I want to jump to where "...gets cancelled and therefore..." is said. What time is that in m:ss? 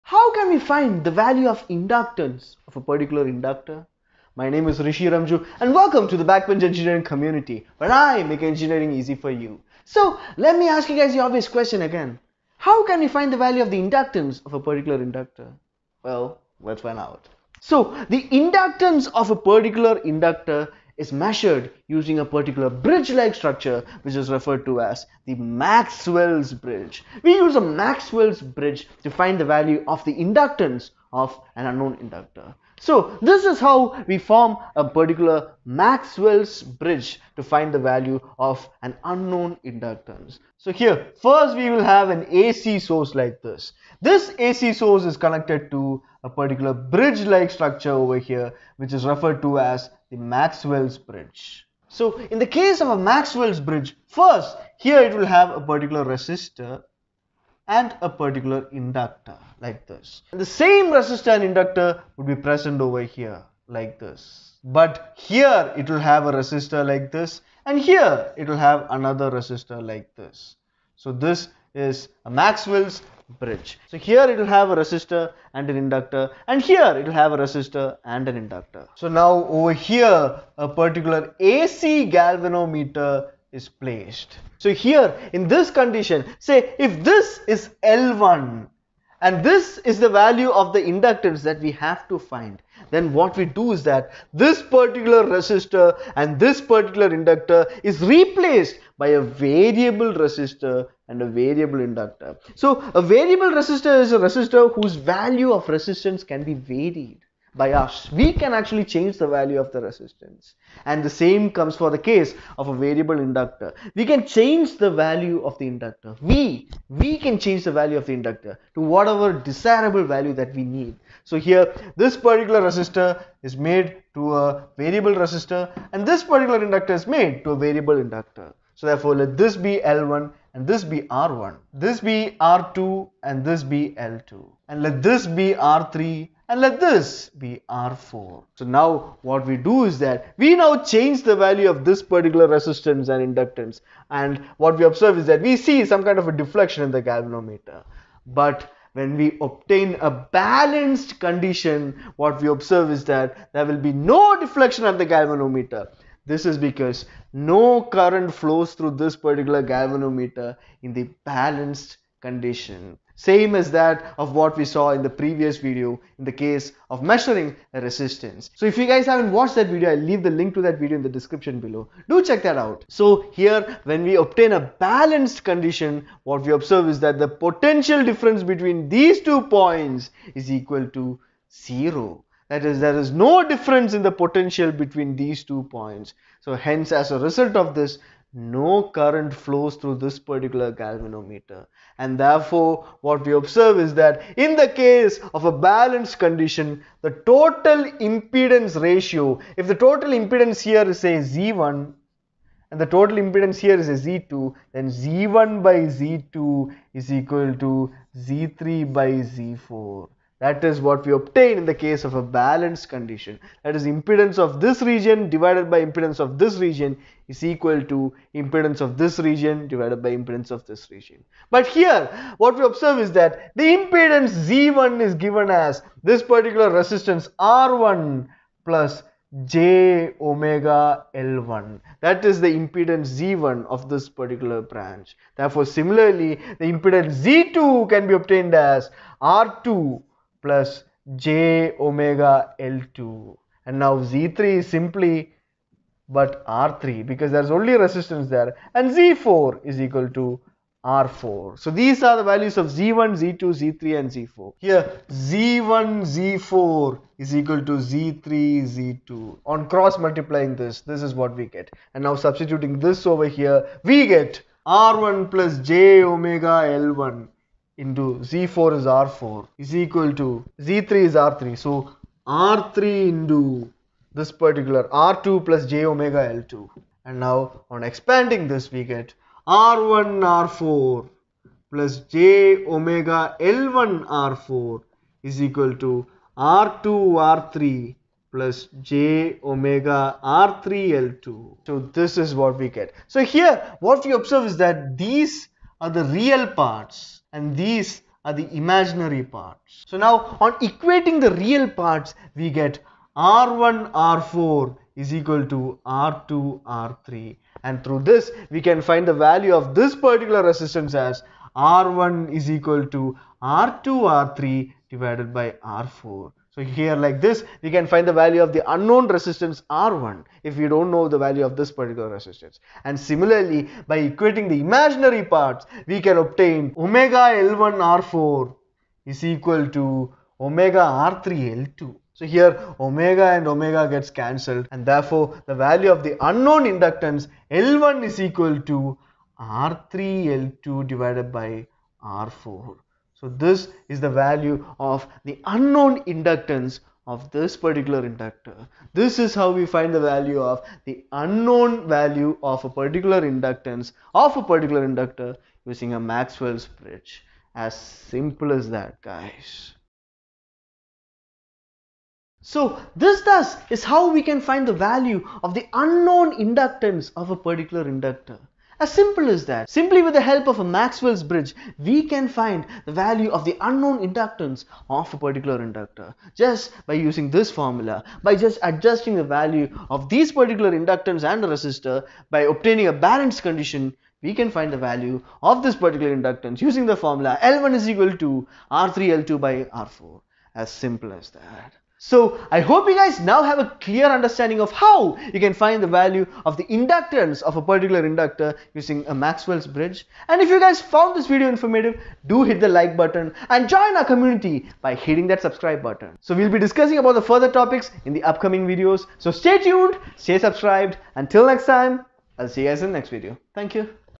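5:33.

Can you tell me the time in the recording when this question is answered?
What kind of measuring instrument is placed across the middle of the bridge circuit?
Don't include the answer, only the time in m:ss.
1:21.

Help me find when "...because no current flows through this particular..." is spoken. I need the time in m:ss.
2:36.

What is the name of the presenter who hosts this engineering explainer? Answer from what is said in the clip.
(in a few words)
Rishi Remju.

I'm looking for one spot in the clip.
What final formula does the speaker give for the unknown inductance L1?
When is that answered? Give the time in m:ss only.
6:27.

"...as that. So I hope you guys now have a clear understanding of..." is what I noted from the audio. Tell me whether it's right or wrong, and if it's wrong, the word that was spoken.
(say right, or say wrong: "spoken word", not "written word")
right.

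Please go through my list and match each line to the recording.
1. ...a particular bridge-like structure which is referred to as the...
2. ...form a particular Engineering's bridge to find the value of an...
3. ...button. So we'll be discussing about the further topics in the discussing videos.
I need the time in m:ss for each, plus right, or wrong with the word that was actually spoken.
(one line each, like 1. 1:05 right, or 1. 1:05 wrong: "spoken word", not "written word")
1. 0:22 right
2. 0:34 wrong: "Maxwell", not "Engineering"
3. 6:45 wrong: "upcoming", not "discussing".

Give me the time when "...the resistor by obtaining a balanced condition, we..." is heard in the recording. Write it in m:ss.
6:21.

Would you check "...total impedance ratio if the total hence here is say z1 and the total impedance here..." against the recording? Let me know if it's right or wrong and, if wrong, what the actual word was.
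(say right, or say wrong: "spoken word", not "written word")
wrong: "impedance", not "hence".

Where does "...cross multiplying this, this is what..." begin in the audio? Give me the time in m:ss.
4:19.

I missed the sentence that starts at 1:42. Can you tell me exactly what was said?
So a variable resistor is a resistor whose value of resistance can be varied by us.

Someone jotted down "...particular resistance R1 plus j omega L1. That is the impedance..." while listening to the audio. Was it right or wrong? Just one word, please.
right.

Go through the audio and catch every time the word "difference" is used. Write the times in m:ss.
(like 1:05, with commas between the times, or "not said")
2:58, 3:03.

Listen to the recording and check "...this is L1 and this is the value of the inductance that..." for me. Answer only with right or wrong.
right.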